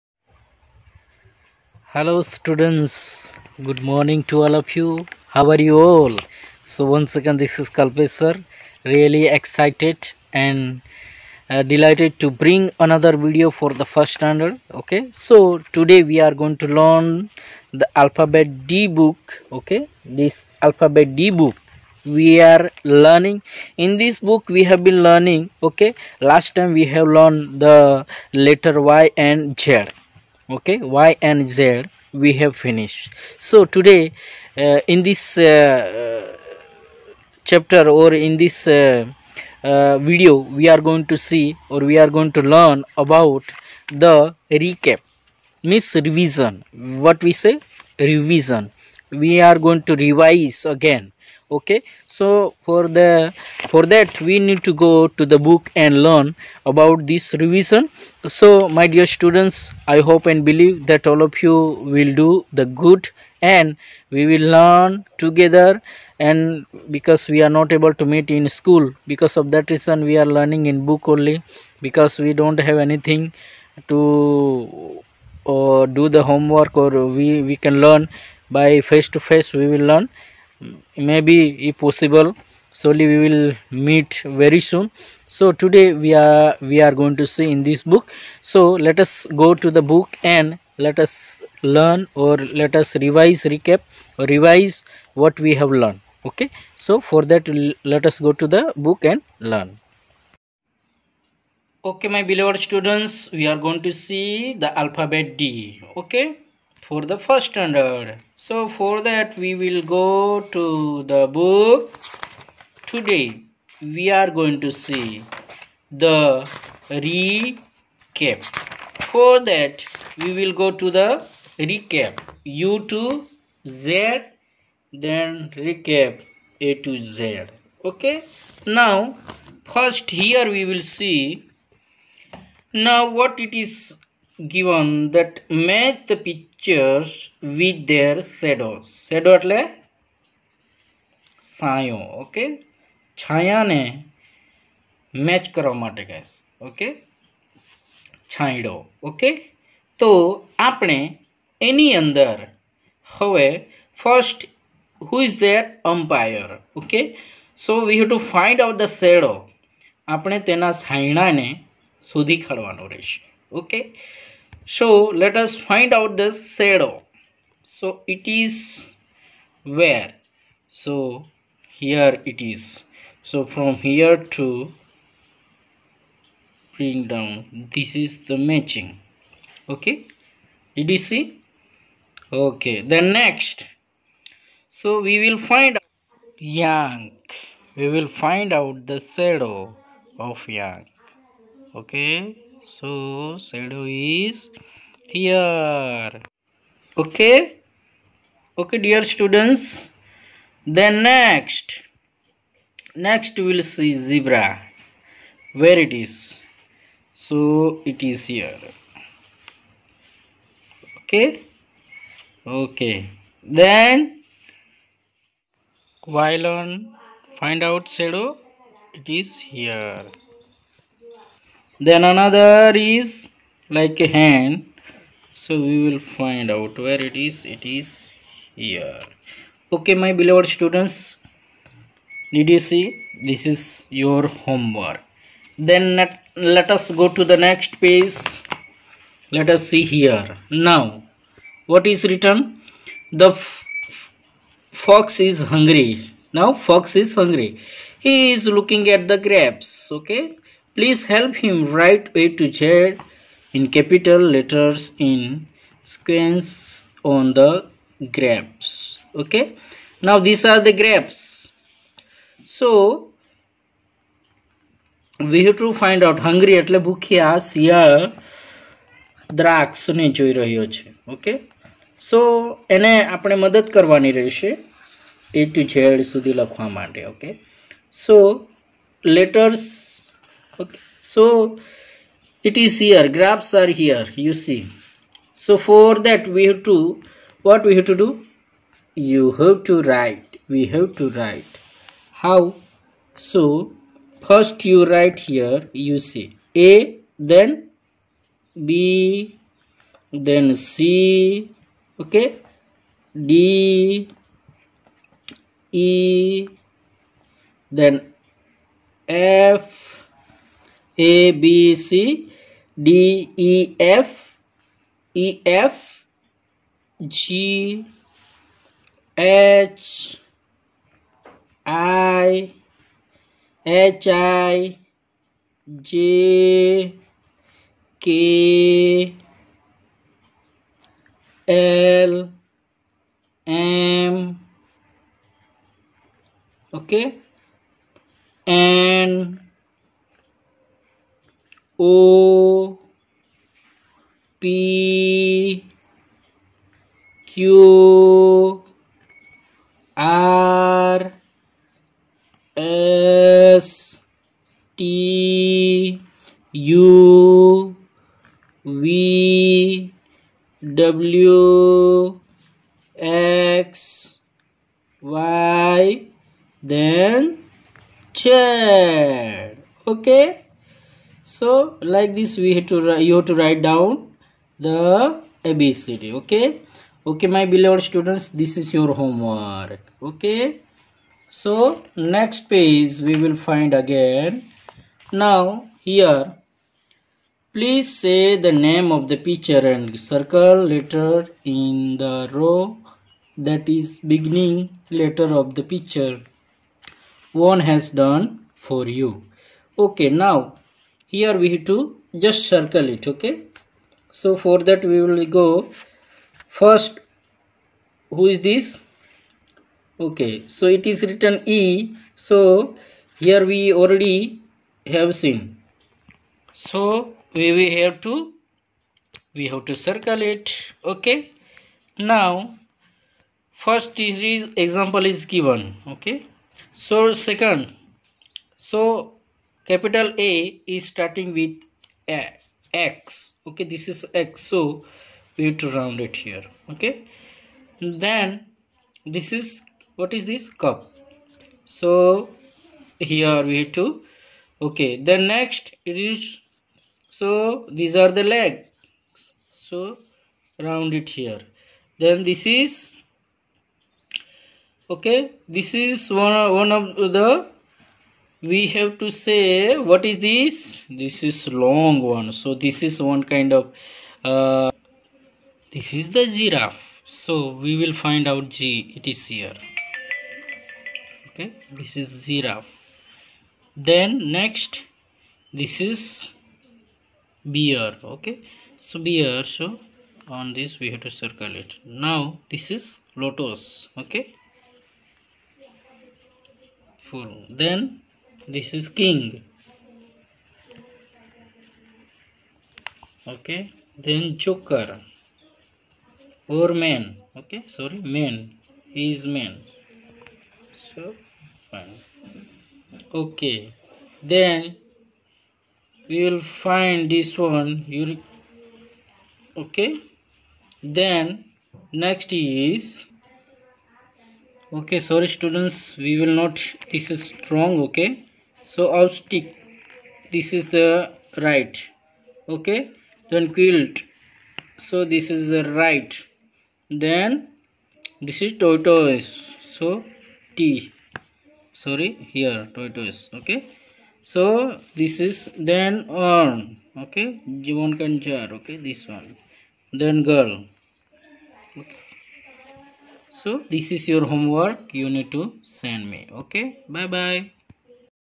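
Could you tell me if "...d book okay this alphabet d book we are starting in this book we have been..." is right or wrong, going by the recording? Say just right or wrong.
wrong.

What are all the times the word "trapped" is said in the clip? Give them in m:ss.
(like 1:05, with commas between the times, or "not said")
not said.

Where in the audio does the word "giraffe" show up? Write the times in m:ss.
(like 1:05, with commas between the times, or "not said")
7:46, 7:52.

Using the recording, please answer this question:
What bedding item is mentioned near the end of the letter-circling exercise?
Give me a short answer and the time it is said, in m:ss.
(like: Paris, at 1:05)
Quilt, at 8:43.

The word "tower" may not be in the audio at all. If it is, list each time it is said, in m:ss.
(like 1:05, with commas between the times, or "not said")
not said.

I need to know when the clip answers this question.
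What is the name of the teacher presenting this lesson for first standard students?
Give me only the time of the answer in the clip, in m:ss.
0:07.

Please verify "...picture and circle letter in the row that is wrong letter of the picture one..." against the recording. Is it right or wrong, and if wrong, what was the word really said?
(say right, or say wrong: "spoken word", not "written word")
wrong: "beginning", not "wrong".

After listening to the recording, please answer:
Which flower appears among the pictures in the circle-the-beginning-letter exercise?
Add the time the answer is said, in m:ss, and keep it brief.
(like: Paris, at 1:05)
Lotus, at 8:03.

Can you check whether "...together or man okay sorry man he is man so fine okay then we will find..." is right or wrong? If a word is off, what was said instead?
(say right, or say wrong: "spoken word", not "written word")
wrong: "joker", not "together".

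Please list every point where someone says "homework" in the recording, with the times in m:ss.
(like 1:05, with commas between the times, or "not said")
1:16, 3:54, 6:18, 9:04.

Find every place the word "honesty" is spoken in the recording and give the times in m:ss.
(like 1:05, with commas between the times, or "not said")
not said.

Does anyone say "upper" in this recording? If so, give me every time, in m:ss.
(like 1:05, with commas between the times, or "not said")
not said.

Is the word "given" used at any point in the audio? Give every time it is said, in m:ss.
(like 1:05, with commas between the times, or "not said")
2:14, 7:05.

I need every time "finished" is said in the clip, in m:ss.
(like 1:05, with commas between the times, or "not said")
0:32.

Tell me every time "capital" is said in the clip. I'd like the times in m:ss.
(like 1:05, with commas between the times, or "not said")
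4:13, 7:09.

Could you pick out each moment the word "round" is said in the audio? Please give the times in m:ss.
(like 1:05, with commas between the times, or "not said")
7:15, 7:30.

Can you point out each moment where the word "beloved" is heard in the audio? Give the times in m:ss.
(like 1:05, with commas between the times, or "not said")
1:42, 3:50, 6:17.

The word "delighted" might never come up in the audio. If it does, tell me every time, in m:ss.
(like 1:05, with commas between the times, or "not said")
0:11.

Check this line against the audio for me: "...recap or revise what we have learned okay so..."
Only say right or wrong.
right.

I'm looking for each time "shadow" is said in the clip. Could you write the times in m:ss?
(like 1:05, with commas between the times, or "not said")
2:46, 3:08, 3:13, 3:37.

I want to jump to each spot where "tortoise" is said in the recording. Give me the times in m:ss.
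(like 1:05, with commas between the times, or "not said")
8:48, 8:52.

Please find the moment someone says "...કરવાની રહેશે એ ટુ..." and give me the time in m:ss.
4:33.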